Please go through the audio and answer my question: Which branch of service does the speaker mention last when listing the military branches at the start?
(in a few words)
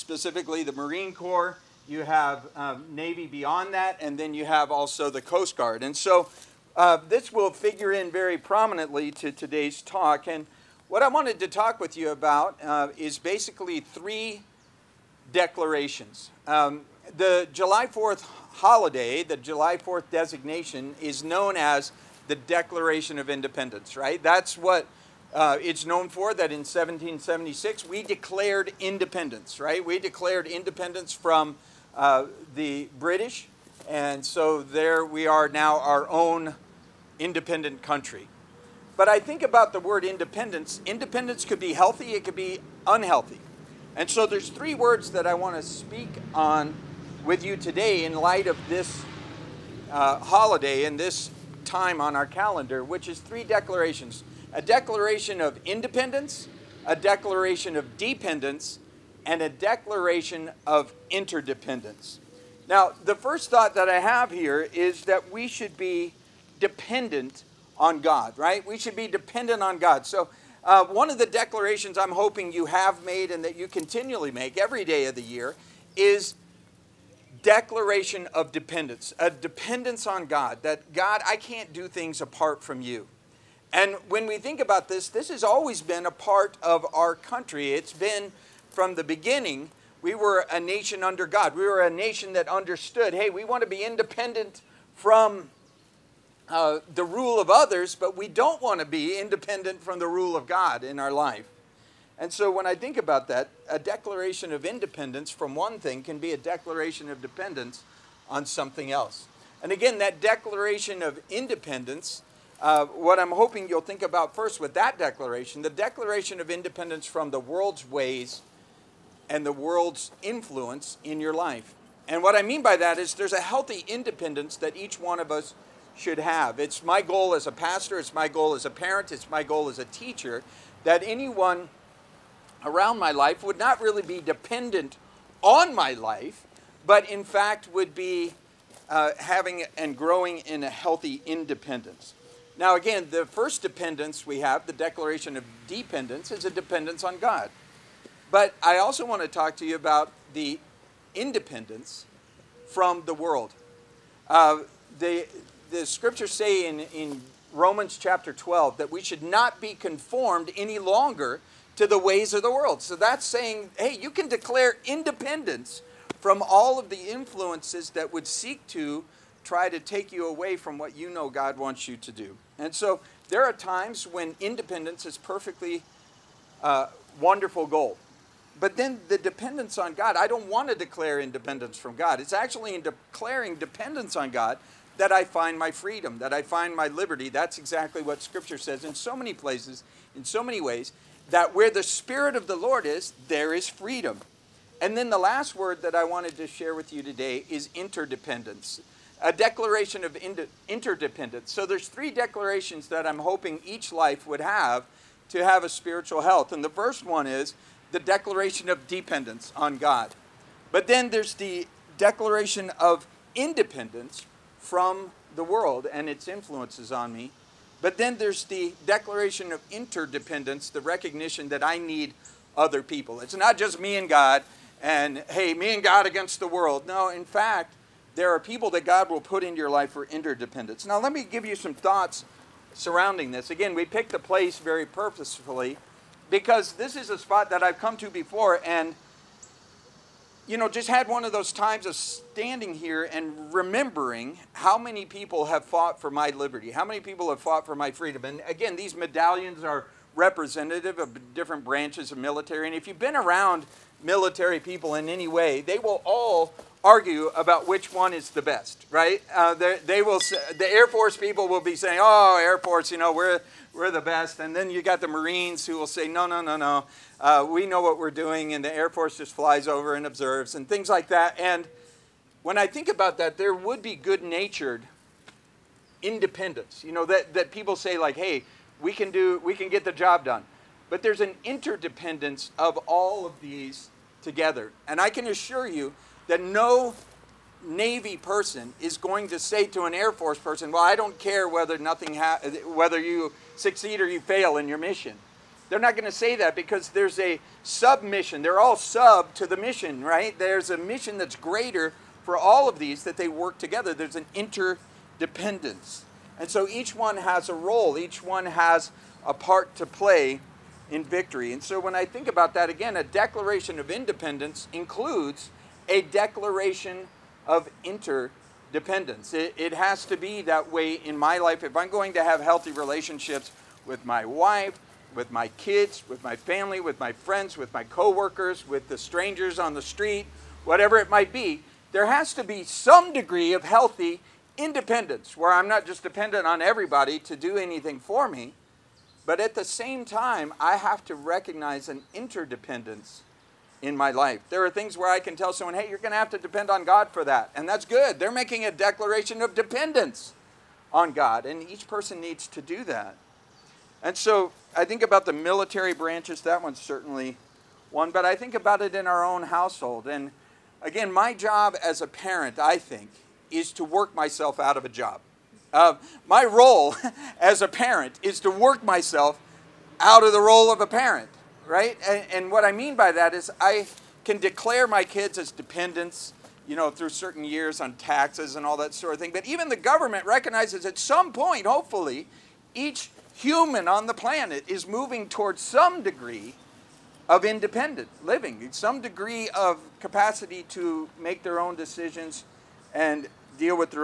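Coast Guard.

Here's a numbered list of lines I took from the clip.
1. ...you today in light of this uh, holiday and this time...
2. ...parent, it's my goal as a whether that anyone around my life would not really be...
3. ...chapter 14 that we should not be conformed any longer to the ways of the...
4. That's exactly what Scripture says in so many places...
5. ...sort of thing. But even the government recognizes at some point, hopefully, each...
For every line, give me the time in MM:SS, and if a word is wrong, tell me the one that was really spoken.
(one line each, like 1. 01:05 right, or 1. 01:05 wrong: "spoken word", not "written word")
1. 00:47 right
2. 02:08 wrong: "teacher", not "whether"
3. 02:37 wrong: "12", not "14"
4. 03:07 right
5. 06:18 right.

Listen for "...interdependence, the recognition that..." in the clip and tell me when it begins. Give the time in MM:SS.
03:39.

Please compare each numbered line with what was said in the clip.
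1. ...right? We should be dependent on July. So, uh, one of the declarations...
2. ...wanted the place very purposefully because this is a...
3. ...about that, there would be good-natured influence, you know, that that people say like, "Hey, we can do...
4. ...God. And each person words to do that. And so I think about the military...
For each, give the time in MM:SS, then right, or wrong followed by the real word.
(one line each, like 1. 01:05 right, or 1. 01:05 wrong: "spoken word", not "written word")
1. 01:08 wrong: "God", not "July"
2. 03:53 wrong: "picked", not "wanted"
3. 04:32 wrong: "independence", not "influence"
4. 05:51 wrong: "needs", not "words".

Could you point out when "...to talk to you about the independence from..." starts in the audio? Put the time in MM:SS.
02:29.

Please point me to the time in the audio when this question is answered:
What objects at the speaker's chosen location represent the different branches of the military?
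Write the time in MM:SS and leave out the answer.
04:08.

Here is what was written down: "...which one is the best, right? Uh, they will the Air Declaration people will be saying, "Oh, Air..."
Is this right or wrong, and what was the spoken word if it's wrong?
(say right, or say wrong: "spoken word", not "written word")
wrong: "Force", not "Declaration".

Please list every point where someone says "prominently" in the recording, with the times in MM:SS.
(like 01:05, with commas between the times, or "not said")
00:08.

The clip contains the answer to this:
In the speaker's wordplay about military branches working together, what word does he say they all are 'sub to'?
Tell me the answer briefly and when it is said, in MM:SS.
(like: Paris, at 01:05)
the mission, at 04:59.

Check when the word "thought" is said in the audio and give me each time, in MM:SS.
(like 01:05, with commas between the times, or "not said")
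01:03, 03:51.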